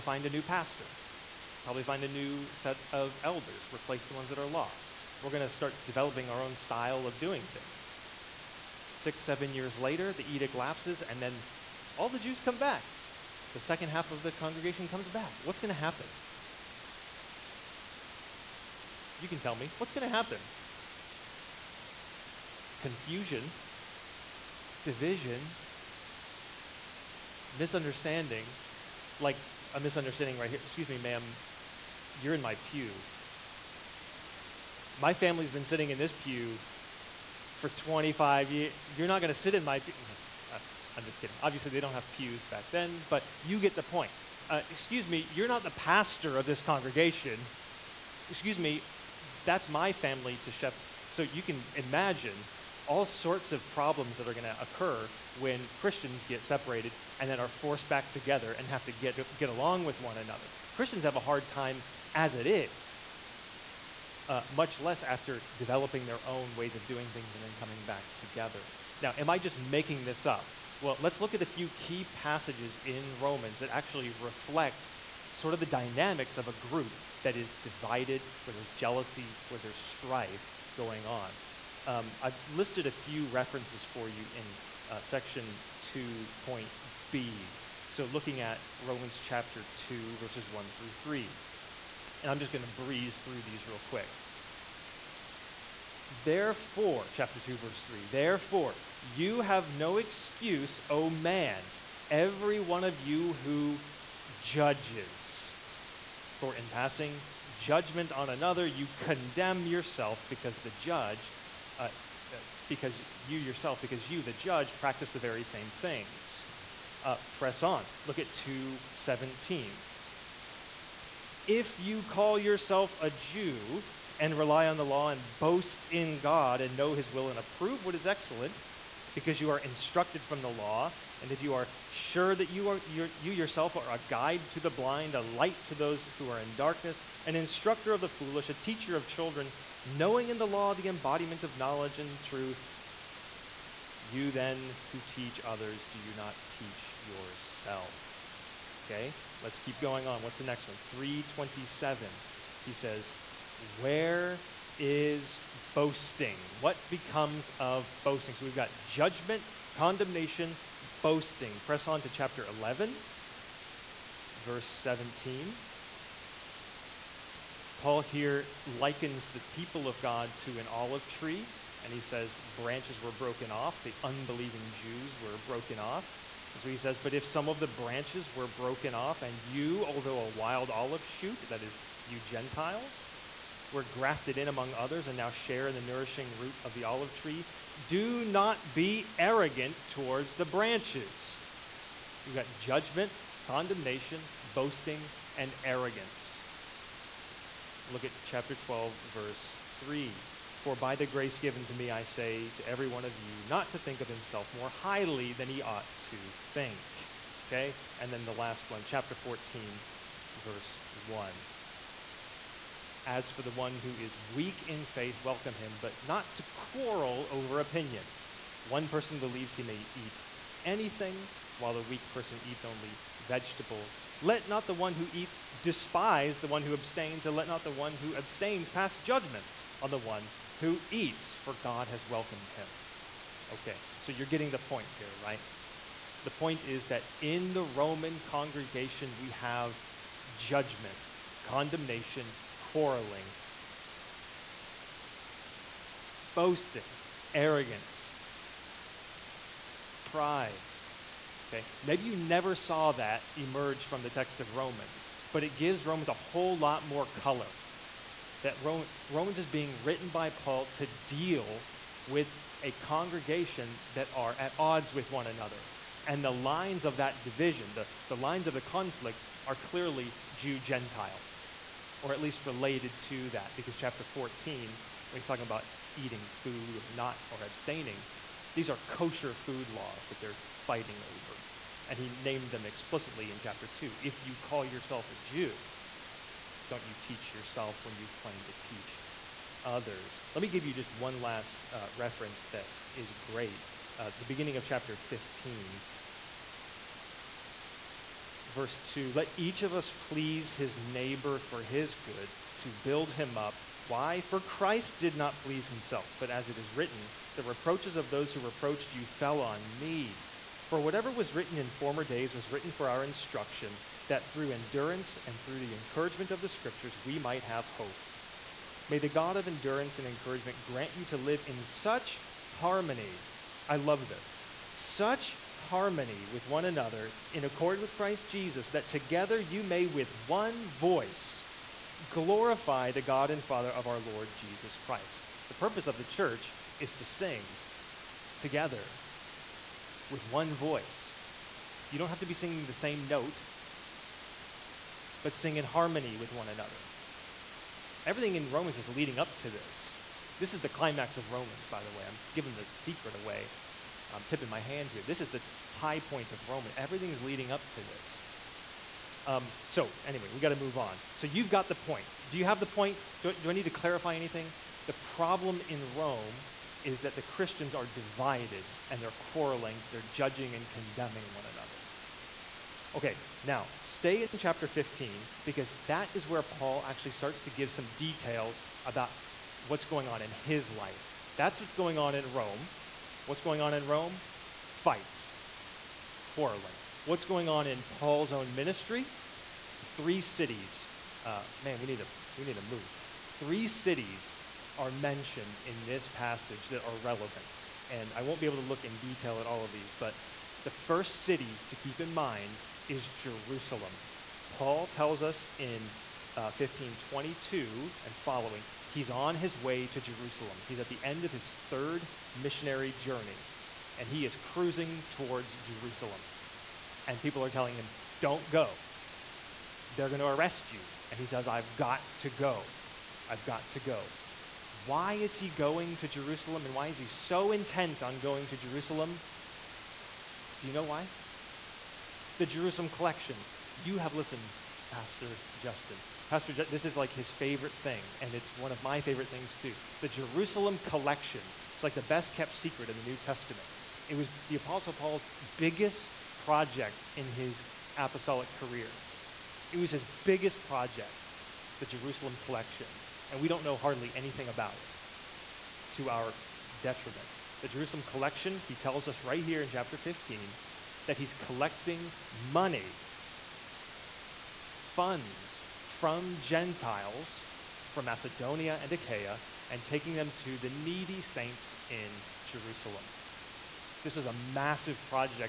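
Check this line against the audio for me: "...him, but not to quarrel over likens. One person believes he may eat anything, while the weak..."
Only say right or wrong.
wrong.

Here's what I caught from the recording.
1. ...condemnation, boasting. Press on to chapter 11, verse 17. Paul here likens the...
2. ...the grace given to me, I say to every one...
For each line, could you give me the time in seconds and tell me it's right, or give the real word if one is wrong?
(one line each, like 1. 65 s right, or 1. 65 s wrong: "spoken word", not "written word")
1. 159 s right
2. 200 s right.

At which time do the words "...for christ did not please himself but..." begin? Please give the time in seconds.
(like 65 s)
304 s.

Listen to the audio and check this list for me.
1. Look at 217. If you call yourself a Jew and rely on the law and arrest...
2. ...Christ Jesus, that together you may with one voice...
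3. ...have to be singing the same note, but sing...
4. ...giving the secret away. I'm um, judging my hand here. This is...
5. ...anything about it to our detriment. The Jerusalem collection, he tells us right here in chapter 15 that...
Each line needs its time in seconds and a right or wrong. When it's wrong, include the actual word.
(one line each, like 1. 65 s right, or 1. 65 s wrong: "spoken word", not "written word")
1. 118 s wrong: "boast", not "arrest"
2. 327 s right
3. 342 s right
4. 352 s wrong: "tipping", not "judging"
5. 454 s right.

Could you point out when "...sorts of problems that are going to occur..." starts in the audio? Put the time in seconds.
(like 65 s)
53 s.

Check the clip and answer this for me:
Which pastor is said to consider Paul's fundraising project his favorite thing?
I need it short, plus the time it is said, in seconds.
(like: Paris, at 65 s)
Pastor Justin, at 434 s.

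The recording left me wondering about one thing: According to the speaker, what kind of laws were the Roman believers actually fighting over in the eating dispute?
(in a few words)
Kosher food laws.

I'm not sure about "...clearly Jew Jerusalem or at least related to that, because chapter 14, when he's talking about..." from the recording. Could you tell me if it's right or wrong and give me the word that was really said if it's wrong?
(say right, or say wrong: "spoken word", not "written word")
wrong: "Gentile", not "Jerusalem".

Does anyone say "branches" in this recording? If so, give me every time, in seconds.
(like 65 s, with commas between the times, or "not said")
172 s, 177 s, 190 s.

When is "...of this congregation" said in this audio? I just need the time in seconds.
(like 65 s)
46 s.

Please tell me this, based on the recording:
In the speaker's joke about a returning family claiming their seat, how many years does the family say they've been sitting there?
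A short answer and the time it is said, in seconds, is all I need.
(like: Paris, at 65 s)
25, at 37 s.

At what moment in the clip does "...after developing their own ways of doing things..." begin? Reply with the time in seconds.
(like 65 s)
65 s.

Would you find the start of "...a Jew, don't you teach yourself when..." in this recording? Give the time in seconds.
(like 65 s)
285 s.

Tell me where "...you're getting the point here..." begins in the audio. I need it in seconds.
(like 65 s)
234 s.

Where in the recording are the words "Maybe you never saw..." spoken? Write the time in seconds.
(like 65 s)
251 s.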